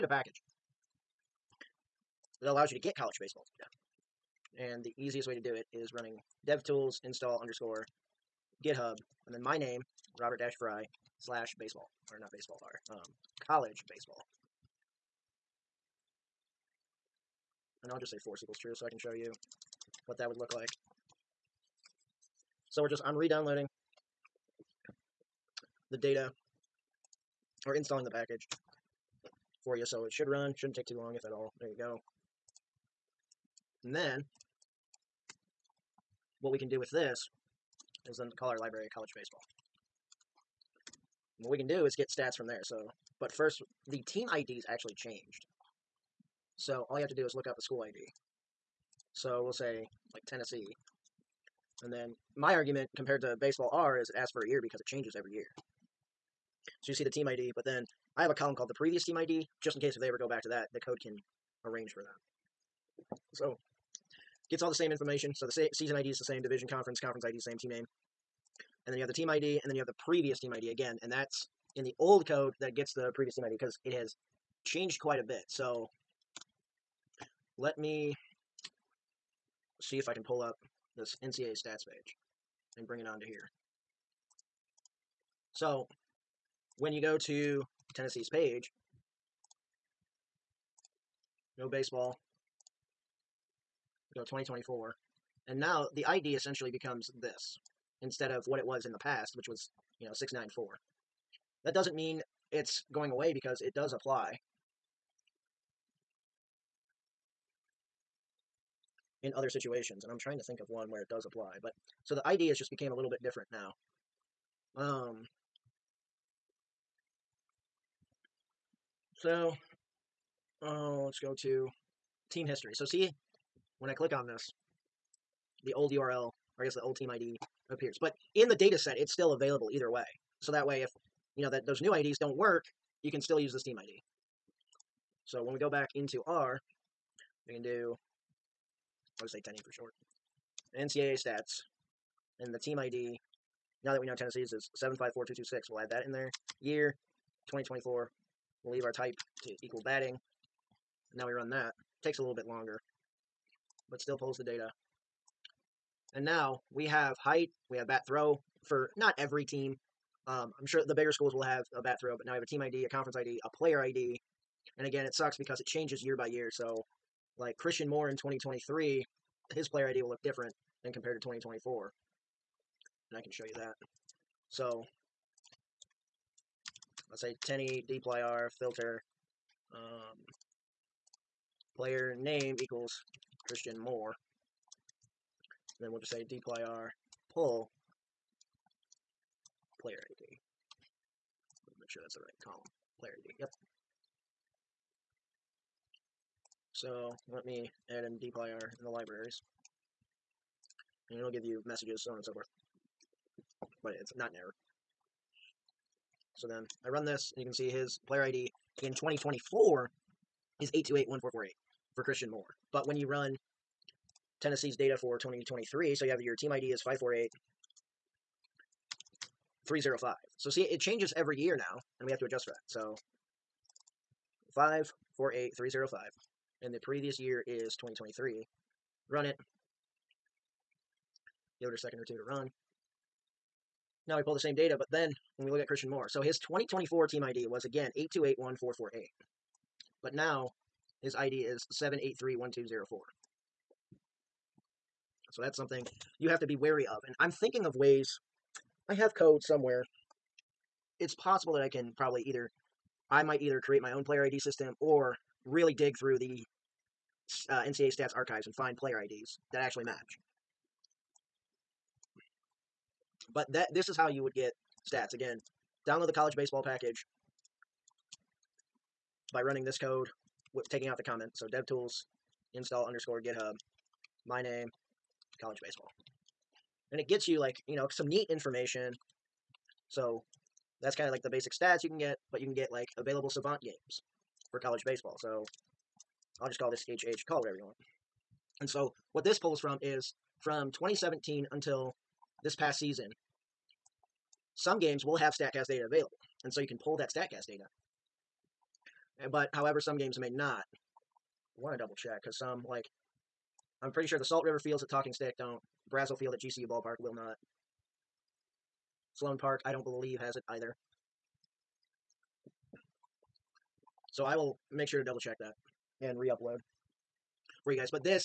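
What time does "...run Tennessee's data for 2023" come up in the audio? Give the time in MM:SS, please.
03:33.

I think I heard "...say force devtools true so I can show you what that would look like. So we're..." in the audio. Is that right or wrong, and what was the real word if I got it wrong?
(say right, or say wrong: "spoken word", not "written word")
wrong: "equals", not "devtools".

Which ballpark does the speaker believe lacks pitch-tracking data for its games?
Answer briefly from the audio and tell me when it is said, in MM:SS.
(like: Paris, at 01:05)
Salt River Fields, at 05:04.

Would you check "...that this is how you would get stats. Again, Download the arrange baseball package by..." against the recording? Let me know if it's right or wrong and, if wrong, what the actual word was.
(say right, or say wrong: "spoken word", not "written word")
wrong: "college", not "arrange".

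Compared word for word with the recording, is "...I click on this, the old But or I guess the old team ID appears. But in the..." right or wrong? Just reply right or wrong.
wrong.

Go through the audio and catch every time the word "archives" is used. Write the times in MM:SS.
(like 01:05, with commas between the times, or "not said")
04:18.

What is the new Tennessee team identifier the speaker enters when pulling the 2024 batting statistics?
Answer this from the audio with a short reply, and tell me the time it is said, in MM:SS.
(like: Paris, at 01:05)
754226, at 02:24.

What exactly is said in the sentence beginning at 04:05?
So that's something you have to be wary of.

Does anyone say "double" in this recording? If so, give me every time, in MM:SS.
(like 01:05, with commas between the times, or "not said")
05:01, 05:15.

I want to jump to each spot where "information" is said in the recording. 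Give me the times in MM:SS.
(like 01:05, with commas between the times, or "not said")
01:04, 04:38.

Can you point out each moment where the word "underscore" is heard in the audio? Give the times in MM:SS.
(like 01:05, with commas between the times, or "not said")
00:07, 04:32.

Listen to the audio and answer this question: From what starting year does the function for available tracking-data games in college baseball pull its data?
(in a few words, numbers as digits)
2017.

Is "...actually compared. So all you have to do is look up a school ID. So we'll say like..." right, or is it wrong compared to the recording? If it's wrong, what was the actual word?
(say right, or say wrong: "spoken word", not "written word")
wrong: "changed", not "compared".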